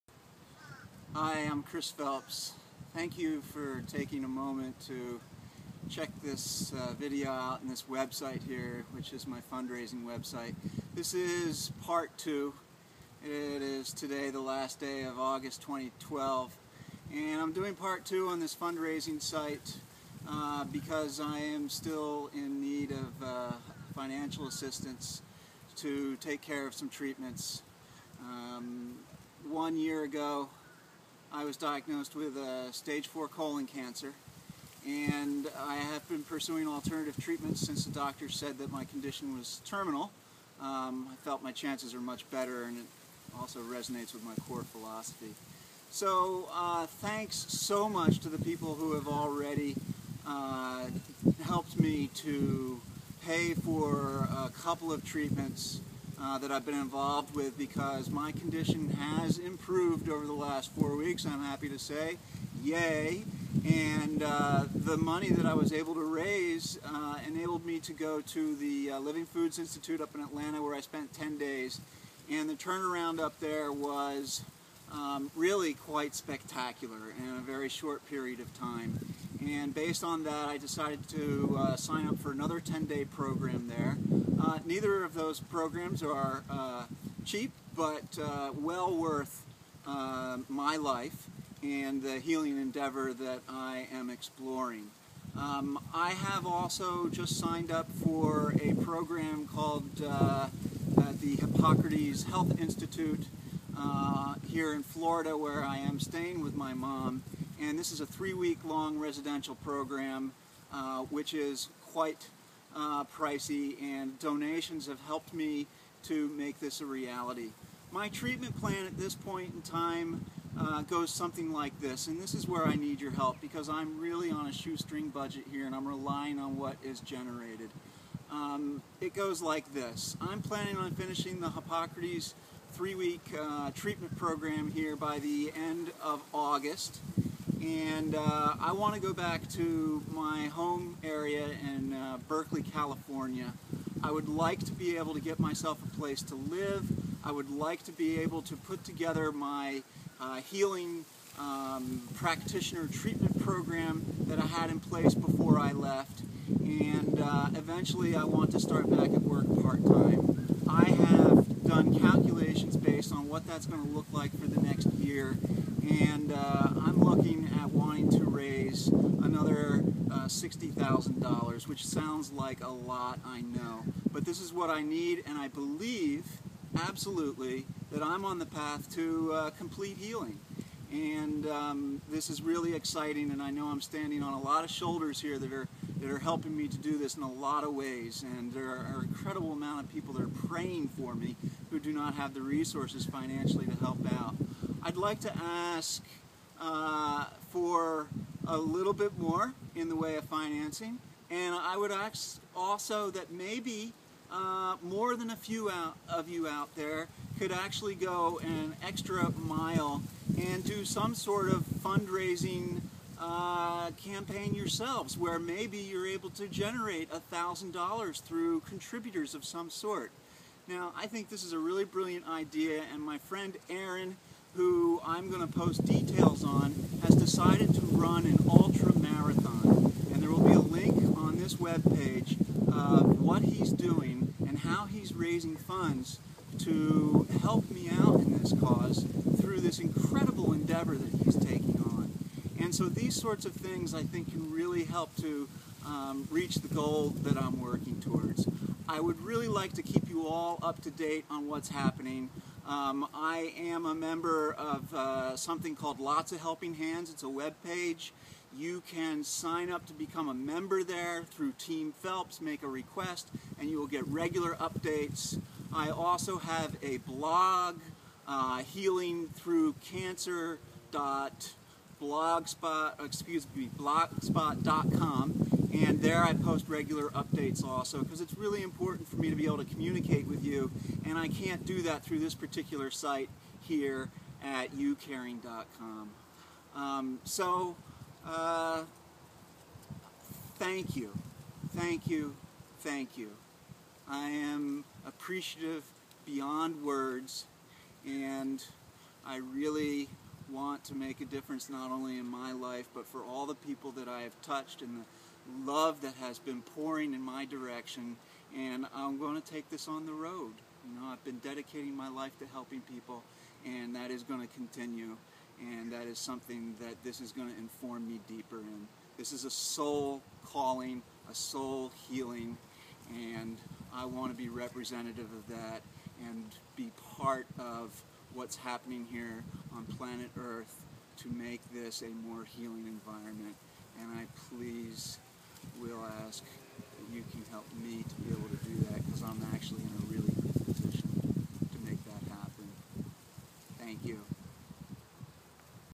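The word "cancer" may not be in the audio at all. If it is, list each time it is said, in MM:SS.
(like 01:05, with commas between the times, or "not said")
00:33, 04:29.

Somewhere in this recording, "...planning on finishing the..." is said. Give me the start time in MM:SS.
02:10.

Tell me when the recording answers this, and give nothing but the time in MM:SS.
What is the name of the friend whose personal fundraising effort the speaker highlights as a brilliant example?
03:43.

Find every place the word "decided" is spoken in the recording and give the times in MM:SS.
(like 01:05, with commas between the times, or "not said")
01:20, 03:47.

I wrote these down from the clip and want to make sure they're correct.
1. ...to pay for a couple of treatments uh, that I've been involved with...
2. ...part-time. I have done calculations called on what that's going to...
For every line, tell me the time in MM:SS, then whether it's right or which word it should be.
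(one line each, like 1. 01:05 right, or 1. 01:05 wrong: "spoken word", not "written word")
1. 00:52 right
2. 02:39 wrong: "based", not "called".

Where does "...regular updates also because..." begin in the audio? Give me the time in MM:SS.
04:36.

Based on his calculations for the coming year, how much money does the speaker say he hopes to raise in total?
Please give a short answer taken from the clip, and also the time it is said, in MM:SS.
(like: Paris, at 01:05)
$60,000, at 02:50.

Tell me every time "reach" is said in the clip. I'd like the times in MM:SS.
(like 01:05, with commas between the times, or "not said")
04:06.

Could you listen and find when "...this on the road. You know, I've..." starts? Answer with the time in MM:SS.
05:09.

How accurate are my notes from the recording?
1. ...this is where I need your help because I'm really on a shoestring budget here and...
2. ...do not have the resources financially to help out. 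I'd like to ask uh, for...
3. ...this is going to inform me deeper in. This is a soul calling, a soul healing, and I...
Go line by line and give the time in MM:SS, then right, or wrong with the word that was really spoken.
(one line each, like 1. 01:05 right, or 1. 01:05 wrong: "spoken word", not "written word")
1. 02:02 right
2. 03:11 right
3. 05:17 right.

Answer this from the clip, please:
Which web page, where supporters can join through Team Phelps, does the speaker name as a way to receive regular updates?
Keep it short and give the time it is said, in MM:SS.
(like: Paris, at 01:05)
Lots of Helping Hands, at 04:15.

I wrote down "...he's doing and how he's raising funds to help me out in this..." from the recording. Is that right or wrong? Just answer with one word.
right.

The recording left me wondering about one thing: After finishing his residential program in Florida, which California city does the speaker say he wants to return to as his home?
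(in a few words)
Berkeley.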